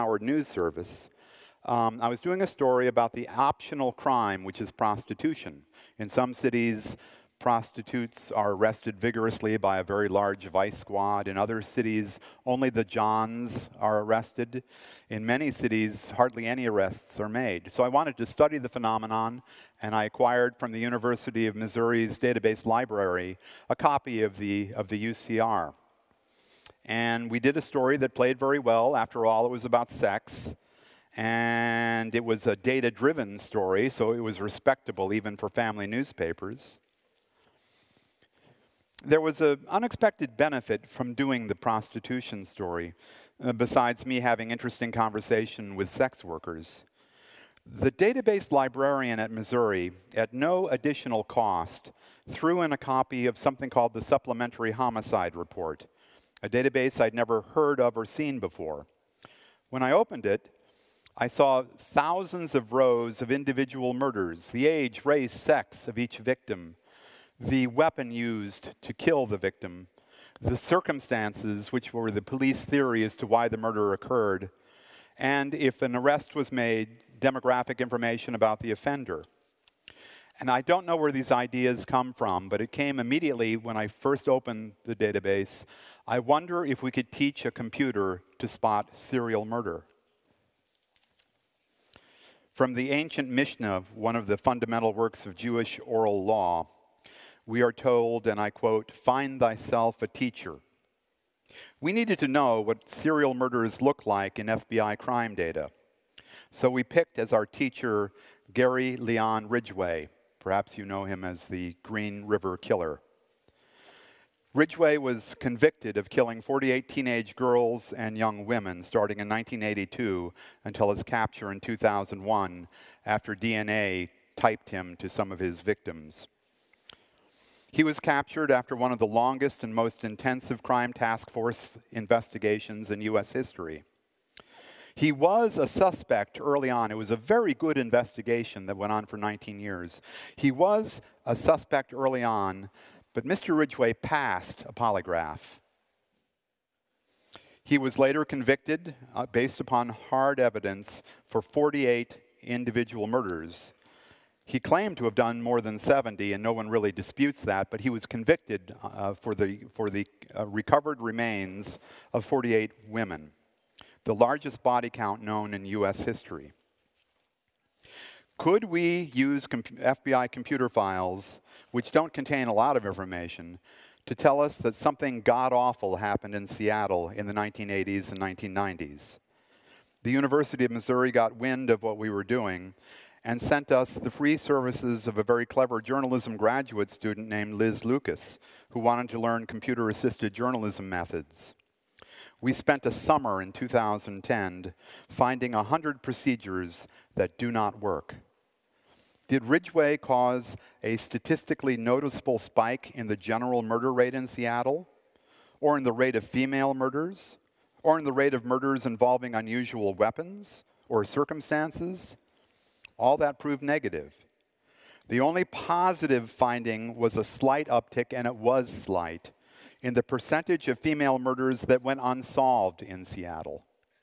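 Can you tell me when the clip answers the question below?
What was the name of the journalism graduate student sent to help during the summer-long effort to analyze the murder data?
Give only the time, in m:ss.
3:07.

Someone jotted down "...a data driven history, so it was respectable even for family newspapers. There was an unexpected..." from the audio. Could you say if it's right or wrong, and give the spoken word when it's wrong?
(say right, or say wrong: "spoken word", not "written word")
wrong: "story", not "history".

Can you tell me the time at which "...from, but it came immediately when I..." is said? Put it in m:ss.
1:22.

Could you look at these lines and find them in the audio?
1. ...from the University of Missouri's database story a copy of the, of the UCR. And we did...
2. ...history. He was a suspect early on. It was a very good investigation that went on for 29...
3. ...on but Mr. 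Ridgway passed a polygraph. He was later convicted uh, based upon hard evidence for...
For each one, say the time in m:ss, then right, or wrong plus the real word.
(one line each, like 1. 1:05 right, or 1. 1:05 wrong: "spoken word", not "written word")
1. 0:20 wrong: "library", not "story"
2. 2:13 wrong: "19", not "29"
3. 2:22 right.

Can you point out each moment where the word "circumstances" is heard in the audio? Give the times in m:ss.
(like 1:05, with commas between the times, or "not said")
1:10, 3:31.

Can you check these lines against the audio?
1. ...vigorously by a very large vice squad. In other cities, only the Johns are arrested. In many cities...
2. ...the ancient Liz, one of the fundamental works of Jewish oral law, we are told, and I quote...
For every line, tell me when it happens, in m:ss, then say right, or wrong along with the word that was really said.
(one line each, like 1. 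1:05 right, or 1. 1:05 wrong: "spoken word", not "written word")
1. 0:09 right
2. 1:32 wrong: "Mishnah", not "Liz".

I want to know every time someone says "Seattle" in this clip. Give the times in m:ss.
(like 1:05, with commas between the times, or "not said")
2:56, 3:24, 3:43.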